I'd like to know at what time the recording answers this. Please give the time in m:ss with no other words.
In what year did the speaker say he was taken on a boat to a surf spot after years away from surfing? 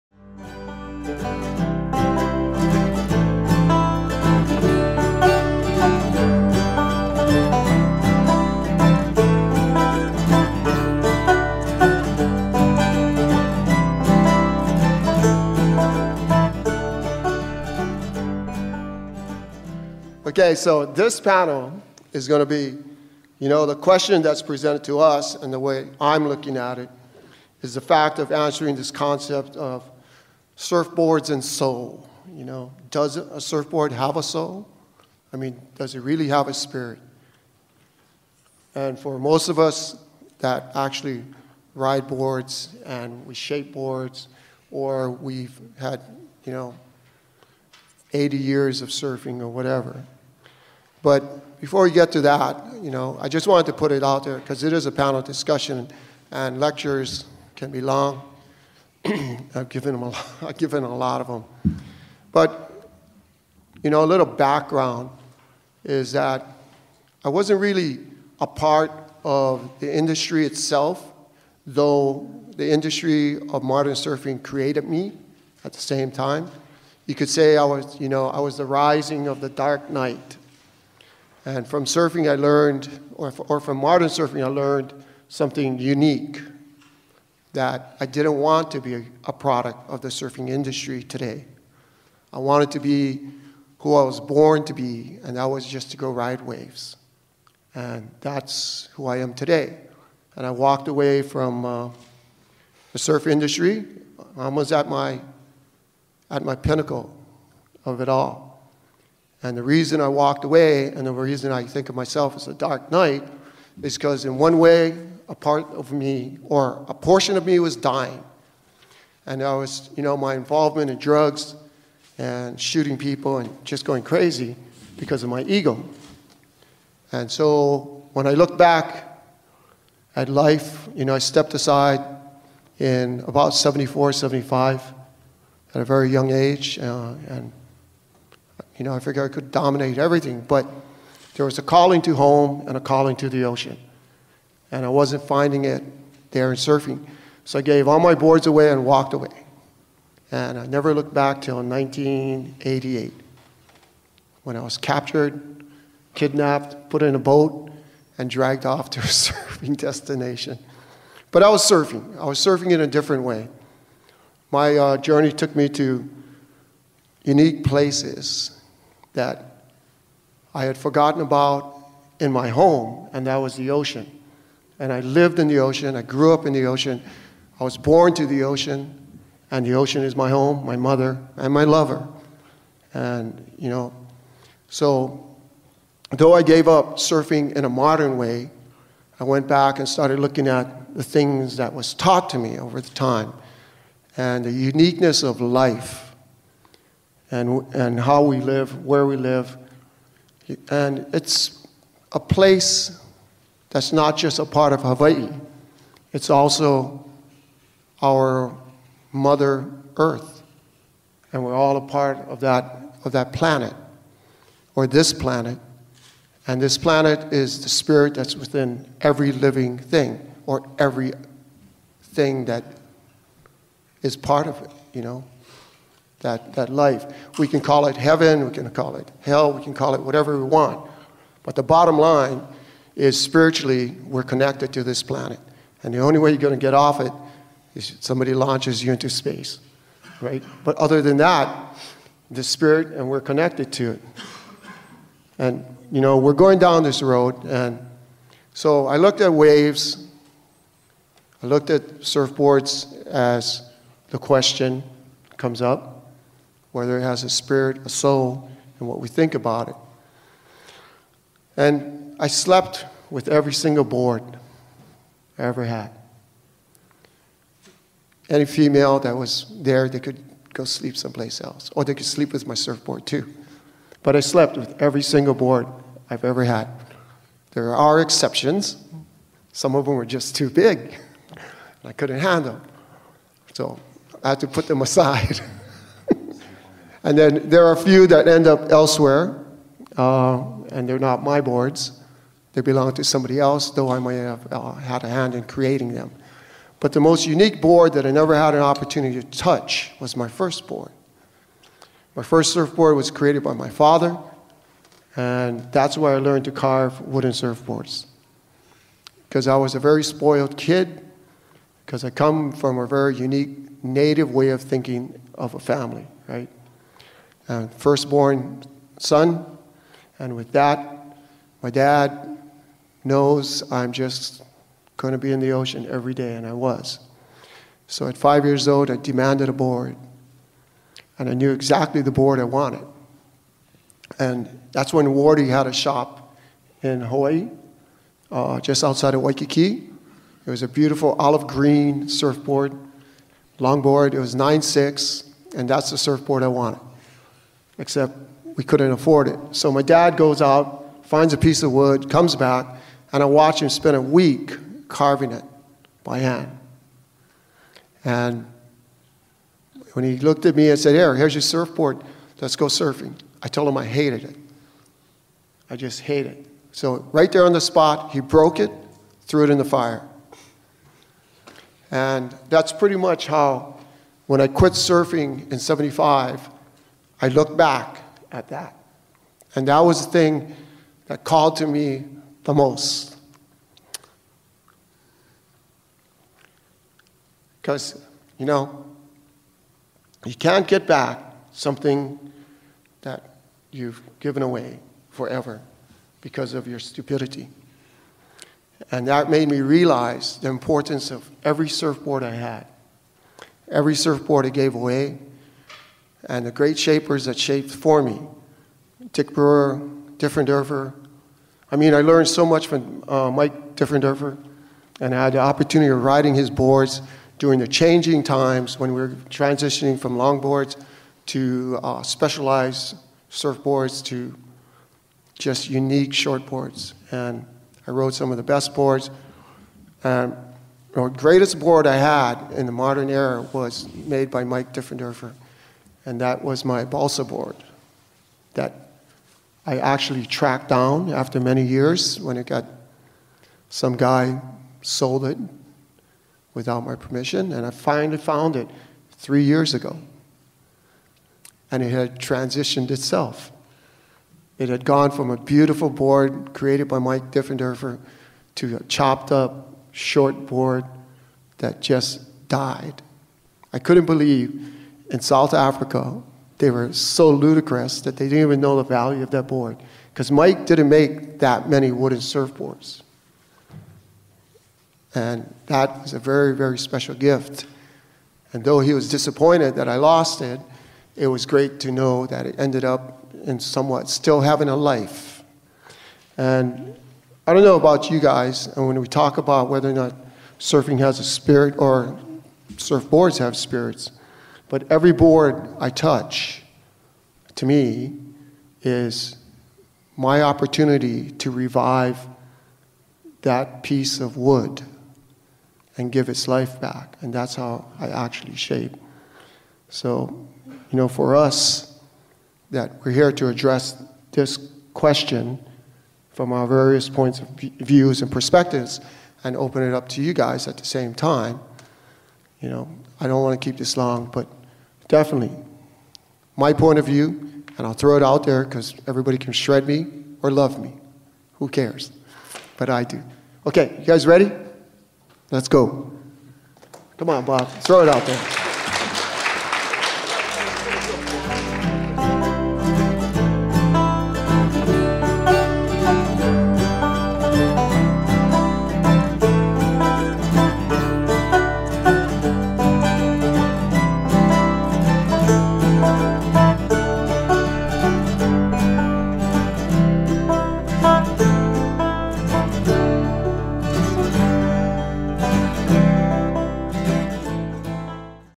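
2:31.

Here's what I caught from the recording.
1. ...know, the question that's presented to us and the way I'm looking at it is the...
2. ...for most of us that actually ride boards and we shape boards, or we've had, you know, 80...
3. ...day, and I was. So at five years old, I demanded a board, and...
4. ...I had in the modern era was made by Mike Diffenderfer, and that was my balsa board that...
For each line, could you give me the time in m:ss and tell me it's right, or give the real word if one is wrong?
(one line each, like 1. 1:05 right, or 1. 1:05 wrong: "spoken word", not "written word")
1. 0:23 right
2. 0:38 right
3. 5:26 right
4. 7:11 right.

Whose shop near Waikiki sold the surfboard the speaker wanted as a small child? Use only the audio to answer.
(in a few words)
Wardy.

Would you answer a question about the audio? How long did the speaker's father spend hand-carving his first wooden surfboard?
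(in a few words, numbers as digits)
A week.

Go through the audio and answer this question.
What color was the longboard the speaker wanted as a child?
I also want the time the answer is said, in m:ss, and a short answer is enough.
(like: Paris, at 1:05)
Olive green, at 5:41.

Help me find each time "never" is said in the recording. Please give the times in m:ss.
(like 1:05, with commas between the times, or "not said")
2:30, 4:58.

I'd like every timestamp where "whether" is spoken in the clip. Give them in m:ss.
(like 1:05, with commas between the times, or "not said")
4:16, 8:09.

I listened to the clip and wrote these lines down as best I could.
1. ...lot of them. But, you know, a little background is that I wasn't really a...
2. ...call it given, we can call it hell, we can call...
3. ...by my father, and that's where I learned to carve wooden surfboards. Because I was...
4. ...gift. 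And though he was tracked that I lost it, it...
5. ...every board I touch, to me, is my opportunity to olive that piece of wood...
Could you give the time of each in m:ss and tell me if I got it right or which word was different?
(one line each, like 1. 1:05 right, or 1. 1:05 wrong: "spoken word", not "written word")
1. 1:00 right
2. 3:47 wrong: "heaven", not "given"
3. 5:03 right
4. 7:57 wrong: "disappointed", not "tracked"
5. 8:14 wrong: "revive", not "olive".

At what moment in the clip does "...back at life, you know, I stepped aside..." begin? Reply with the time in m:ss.
2:08.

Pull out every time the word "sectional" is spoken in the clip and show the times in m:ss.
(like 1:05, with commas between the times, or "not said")
not said.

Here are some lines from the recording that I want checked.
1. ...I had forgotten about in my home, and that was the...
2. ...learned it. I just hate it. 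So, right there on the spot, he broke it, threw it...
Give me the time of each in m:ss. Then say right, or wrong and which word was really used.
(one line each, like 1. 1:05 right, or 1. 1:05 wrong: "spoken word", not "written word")
1. 2:50 right
2. 6:03 wrong: "hated", not "learned".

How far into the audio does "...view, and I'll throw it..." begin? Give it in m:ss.
8:47.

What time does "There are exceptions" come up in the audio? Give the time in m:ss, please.
4:37.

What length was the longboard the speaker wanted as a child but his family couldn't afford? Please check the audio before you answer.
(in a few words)
9.6.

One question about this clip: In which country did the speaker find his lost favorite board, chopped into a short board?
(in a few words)
South Africa.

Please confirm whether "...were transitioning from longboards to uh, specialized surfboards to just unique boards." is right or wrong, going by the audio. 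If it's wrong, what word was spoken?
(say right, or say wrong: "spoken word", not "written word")
wrong: "shortboards", not "boards".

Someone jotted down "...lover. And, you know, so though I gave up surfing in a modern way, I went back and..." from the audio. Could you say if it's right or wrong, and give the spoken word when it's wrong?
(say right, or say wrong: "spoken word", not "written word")
right.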